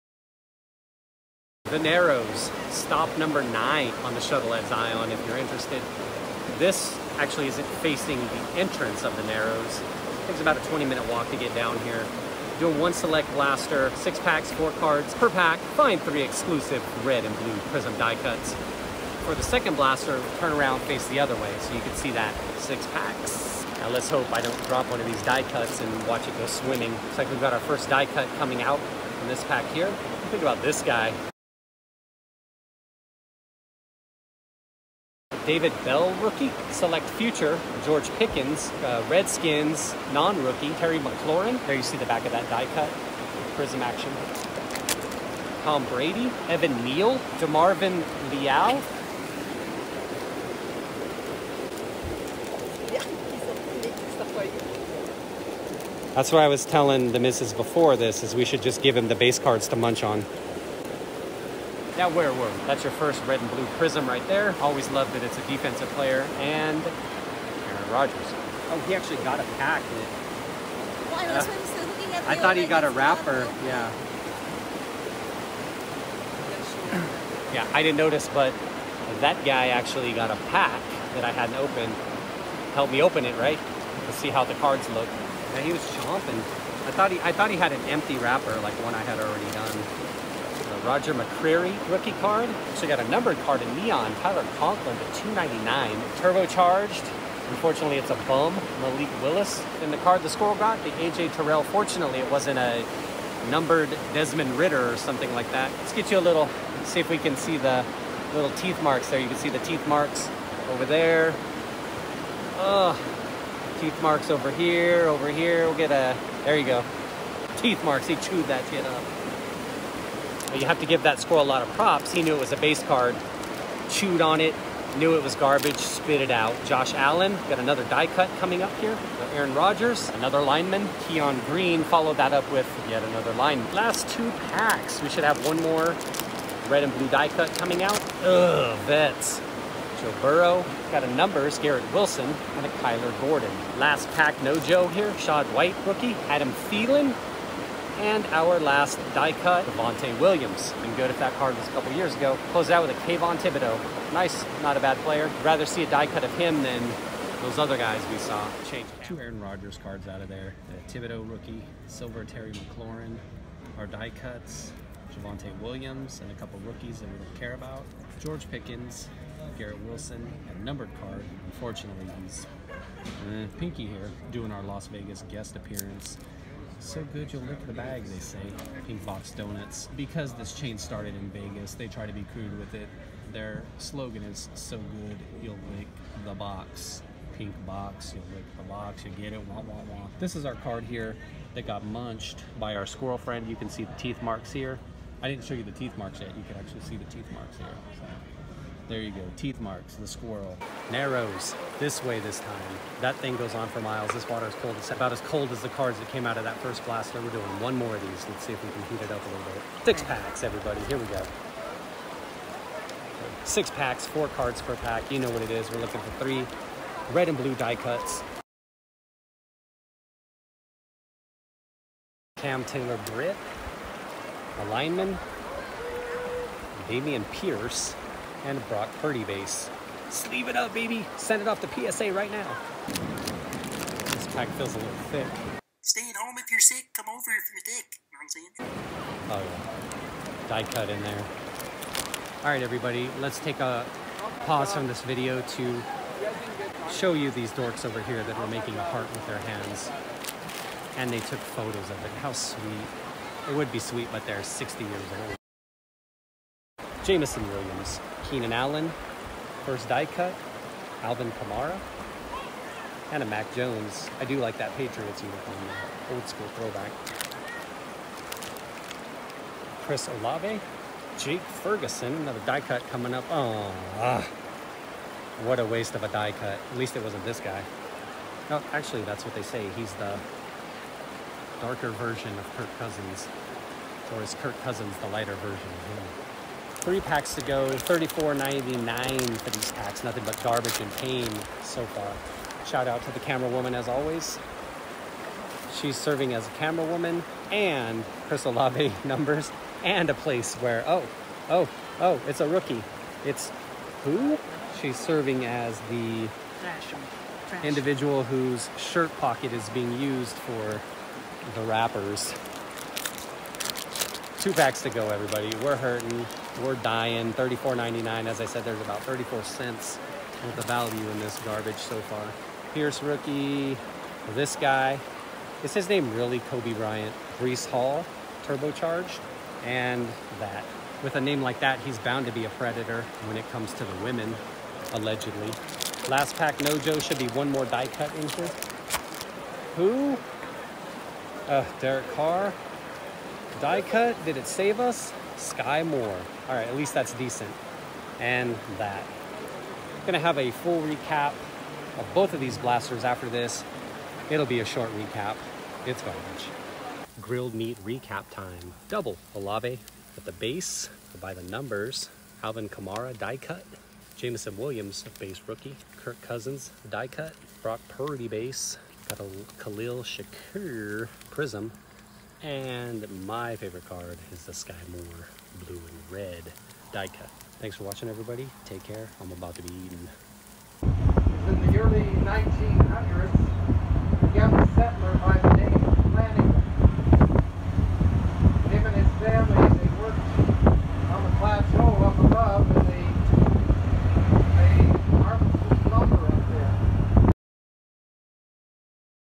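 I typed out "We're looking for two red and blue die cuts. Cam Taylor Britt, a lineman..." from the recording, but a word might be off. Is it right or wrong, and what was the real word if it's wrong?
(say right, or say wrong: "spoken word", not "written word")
wrong: "three", not "two".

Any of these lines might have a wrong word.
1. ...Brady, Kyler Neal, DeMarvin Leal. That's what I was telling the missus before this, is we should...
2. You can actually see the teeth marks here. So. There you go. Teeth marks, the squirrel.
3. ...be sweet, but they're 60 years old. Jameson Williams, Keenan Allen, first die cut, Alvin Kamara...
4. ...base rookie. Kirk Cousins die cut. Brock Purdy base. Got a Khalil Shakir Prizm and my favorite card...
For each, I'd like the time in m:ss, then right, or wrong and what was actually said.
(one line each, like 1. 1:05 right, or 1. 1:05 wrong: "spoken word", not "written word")
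1. 0:45 wrong: "Evan", not "Kyler"
2. 3:16 right
3. 4:13 right
4. 6:05 right.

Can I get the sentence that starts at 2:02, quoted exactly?
He knew it was a base card, chewed on it, knew it was garbage, spit it out.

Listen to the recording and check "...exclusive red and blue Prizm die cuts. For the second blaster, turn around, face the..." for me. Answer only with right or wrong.
right.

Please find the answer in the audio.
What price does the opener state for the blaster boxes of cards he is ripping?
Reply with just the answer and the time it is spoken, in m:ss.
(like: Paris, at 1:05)
$34.99, at 4:47.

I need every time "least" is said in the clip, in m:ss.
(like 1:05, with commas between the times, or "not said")
4:36, 5:46.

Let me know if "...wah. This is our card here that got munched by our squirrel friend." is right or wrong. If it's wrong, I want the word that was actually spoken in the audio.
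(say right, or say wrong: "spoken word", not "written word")
right.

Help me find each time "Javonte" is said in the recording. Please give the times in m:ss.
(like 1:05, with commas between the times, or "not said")
2:29, 2:45.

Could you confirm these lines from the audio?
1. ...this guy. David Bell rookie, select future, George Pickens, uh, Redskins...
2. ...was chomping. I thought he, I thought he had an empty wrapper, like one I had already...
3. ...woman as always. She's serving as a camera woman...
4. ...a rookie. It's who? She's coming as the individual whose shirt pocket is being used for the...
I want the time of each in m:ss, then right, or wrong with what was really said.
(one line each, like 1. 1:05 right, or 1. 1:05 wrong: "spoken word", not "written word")
1. 0:30 right
2. 1:25 right
3. 4:53 right
4. 5:02 wrong: "serving", not "coming".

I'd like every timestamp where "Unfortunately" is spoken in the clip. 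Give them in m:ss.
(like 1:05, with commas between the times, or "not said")
1:37, 2:51.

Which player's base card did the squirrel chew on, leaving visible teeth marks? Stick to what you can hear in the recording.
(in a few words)
AJ Terrell.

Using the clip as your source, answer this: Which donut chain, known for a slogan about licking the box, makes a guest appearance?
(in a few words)
Pink Box Donuts.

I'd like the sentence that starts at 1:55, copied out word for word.
We'll get a, there you go.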